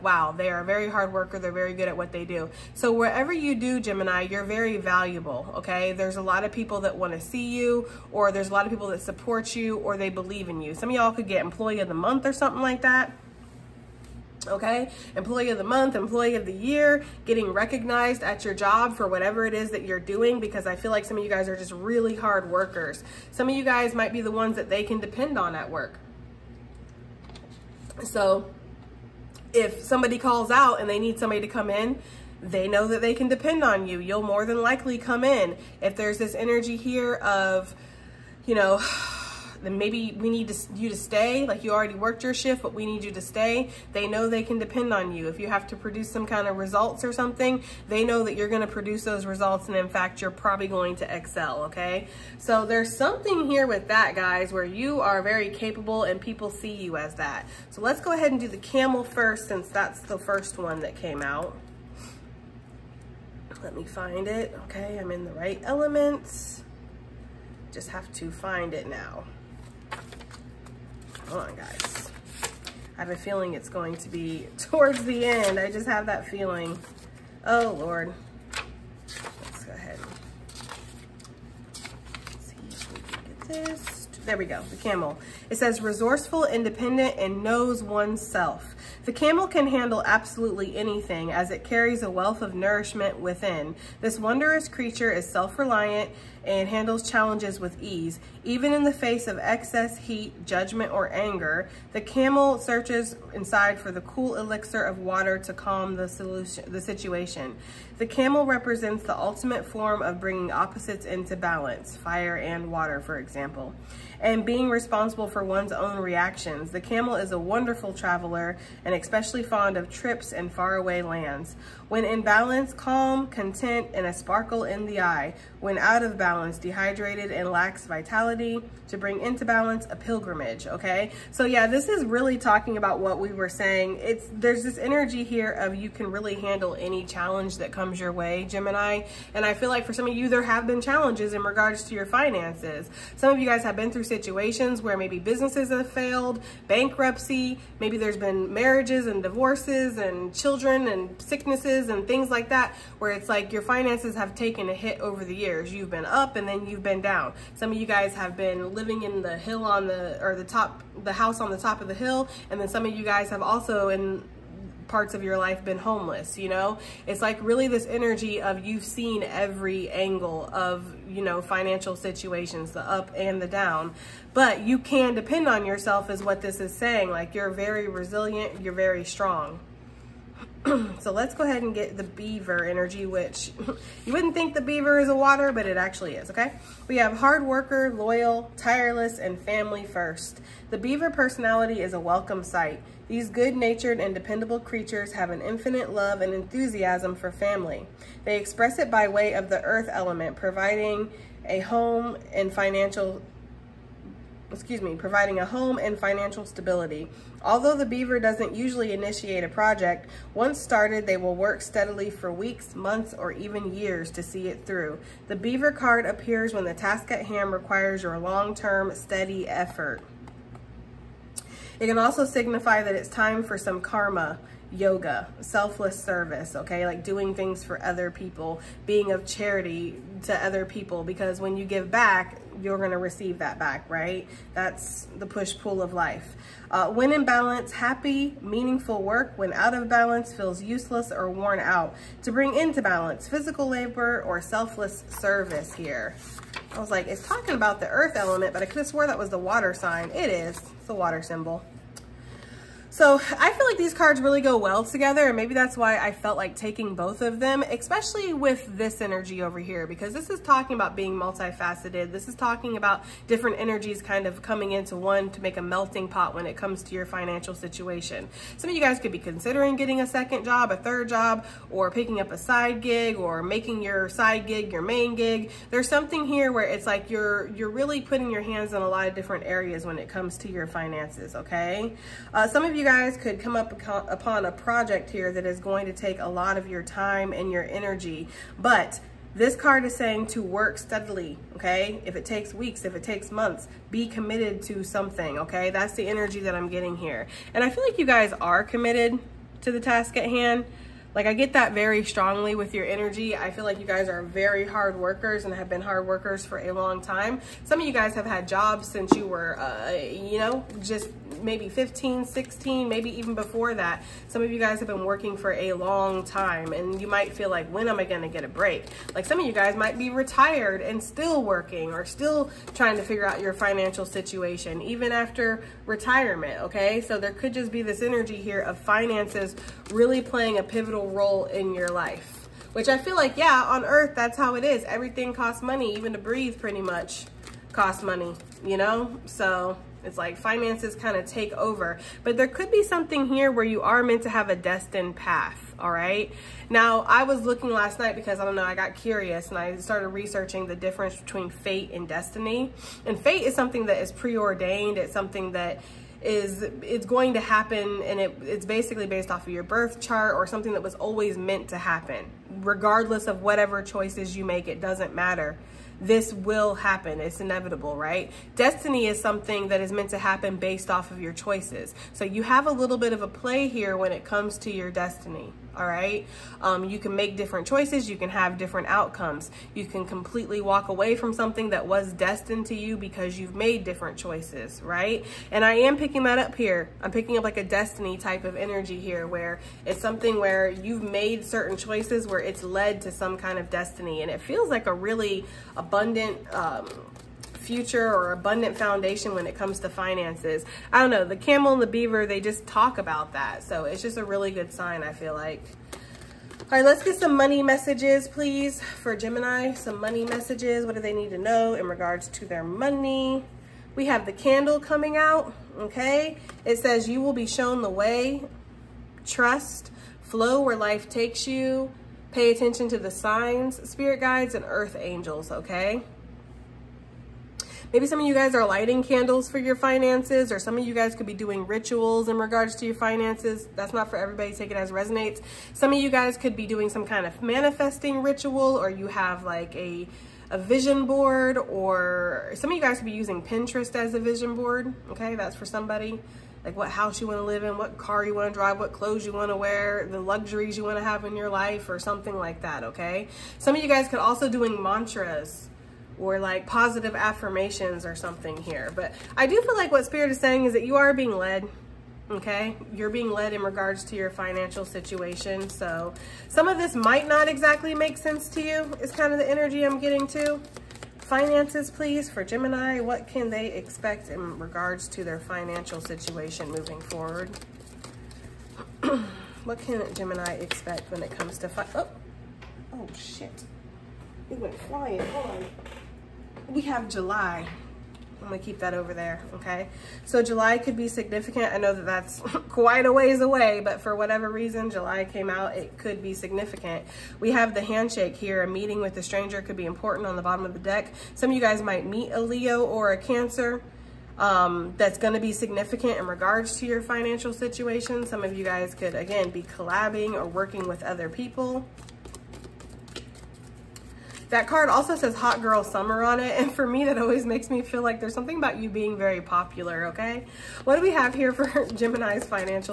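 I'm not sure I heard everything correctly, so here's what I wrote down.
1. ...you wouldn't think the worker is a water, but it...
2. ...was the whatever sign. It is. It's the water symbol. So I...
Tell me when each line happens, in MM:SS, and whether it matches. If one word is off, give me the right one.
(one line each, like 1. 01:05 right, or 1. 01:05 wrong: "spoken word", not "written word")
1. 03:04 wrong: "beaver", not "worker"
2. 04:09 wrong: "water", not "whatever".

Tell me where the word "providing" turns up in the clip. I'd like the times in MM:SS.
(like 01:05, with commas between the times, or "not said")
03:20, 03:24.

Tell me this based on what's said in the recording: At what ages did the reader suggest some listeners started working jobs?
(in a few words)
15, 16.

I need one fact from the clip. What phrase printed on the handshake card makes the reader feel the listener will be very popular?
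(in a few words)
Hot Girl Summer.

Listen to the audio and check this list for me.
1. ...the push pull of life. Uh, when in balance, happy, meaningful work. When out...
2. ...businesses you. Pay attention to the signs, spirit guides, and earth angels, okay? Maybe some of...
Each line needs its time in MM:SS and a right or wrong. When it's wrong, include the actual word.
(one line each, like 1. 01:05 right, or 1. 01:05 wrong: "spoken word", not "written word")
1. 03:55 right
2. 07:01 wrong: "takes", not "businesses".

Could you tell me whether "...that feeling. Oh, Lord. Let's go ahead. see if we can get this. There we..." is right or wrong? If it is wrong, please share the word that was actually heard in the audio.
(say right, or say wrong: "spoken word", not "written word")
right.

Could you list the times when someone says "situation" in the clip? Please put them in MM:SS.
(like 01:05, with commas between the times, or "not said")
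01:46, 02:24, 02:51, 04:27, 05:24, 07:44, 07:55, 08:27.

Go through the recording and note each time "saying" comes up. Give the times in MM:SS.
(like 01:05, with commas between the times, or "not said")
02:13, 02:56, 04:49, 07:40.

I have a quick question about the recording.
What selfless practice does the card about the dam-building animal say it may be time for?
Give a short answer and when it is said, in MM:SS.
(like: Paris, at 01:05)
Karma yoga, at 03:43.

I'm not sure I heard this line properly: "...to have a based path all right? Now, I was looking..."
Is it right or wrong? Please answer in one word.
wrong.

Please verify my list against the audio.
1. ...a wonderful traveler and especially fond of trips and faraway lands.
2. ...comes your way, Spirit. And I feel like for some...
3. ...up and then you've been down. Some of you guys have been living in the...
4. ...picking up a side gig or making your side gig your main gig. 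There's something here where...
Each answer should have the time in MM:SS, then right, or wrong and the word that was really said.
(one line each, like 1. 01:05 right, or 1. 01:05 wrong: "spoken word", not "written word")
1. 01:57 right
2. 02:17 wrong: "Gemini", not "Spirit"
3. 02:36 right
4. 04:31 right.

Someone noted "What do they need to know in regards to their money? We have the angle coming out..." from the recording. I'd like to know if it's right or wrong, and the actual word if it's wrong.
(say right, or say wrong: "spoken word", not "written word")
wrong: "candle", not "angle".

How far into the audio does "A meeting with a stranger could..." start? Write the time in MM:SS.
08:18.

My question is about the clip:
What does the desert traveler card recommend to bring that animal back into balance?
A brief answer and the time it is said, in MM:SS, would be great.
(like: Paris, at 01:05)
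A pilgrimage, at 02:09.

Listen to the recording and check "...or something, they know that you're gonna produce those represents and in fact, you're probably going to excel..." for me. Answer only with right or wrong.
wrong.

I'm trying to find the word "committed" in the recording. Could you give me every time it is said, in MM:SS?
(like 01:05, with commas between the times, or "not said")
04:54, 04:58.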